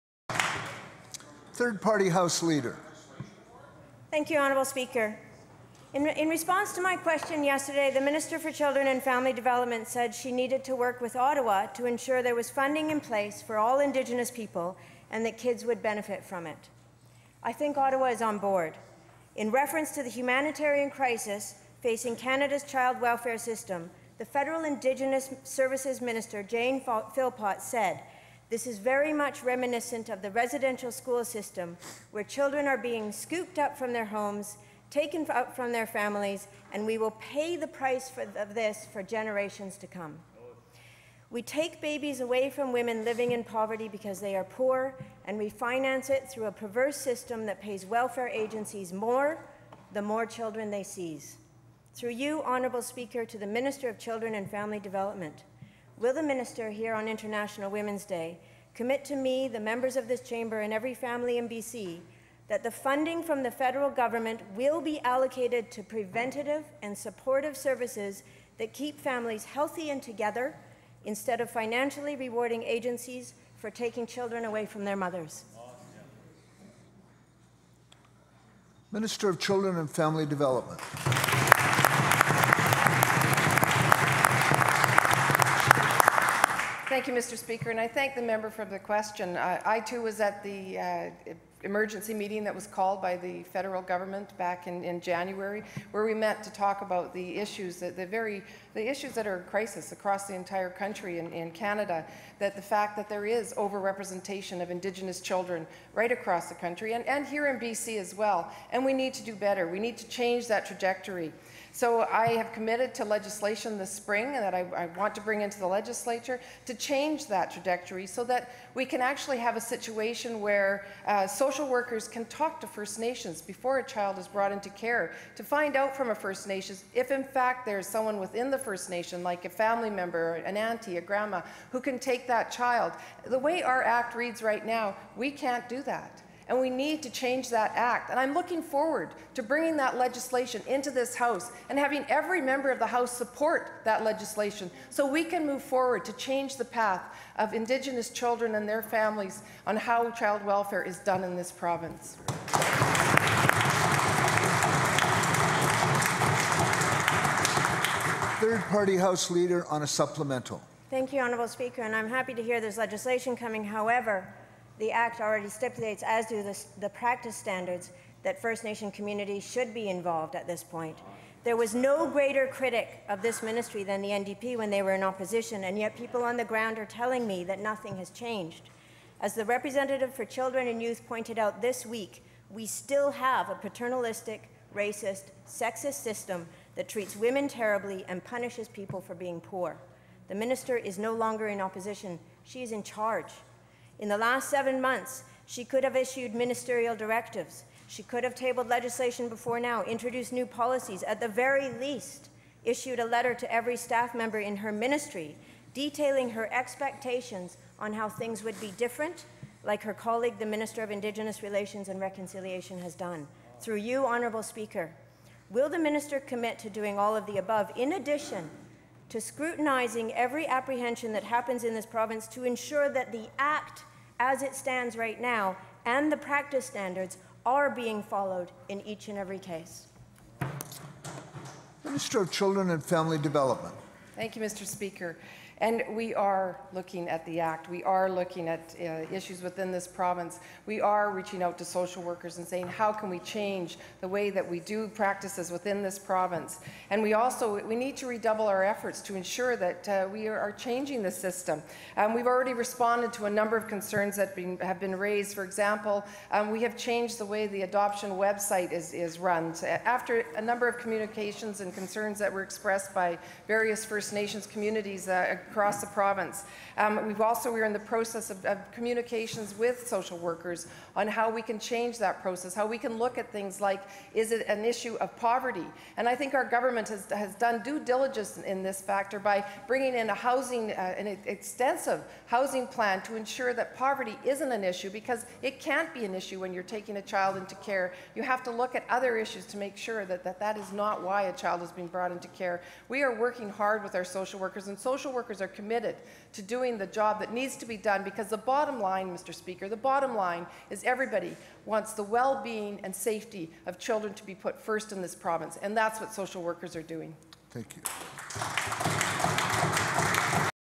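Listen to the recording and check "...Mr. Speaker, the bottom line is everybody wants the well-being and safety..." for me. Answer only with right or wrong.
right.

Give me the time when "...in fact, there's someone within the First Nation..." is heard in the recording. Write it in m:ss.
2:07.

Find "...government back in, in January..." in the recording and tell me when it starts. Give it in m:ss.
1:33.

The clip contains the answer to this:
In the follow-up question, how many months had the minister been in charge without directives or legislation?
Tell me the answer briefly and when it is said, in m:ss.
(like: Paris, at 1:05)
7, at 3:14.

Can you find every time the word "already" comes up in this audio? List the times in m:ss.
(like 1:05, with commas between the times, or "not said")
2:45, 4:12.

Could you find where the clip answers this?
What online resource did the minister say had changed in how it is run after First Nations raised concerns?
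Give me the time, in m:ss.
4:17.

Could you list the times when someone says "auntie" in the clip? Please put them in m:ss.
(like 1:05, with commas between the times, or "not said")
2:10.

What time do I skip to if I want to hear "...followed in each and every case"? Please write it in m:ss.
3:48.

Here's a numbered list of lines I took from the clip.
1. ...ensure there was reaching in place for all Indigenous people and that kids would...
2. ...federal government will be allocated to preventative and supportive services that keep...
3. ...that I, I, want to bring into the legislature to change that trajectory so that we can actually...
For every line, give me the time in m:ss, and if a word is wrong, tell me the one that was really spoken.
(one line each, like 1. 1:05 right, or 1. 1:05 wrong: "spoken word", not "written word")
1. 0:11 wrong: "funding", not "reaching"
2. 1:03 right
3. 1:54 right.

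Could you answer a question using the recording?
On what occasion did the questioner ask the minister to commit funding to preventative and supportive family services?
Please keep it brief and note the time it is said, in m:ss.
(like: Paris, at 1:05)
International Women's Day, at 0:57.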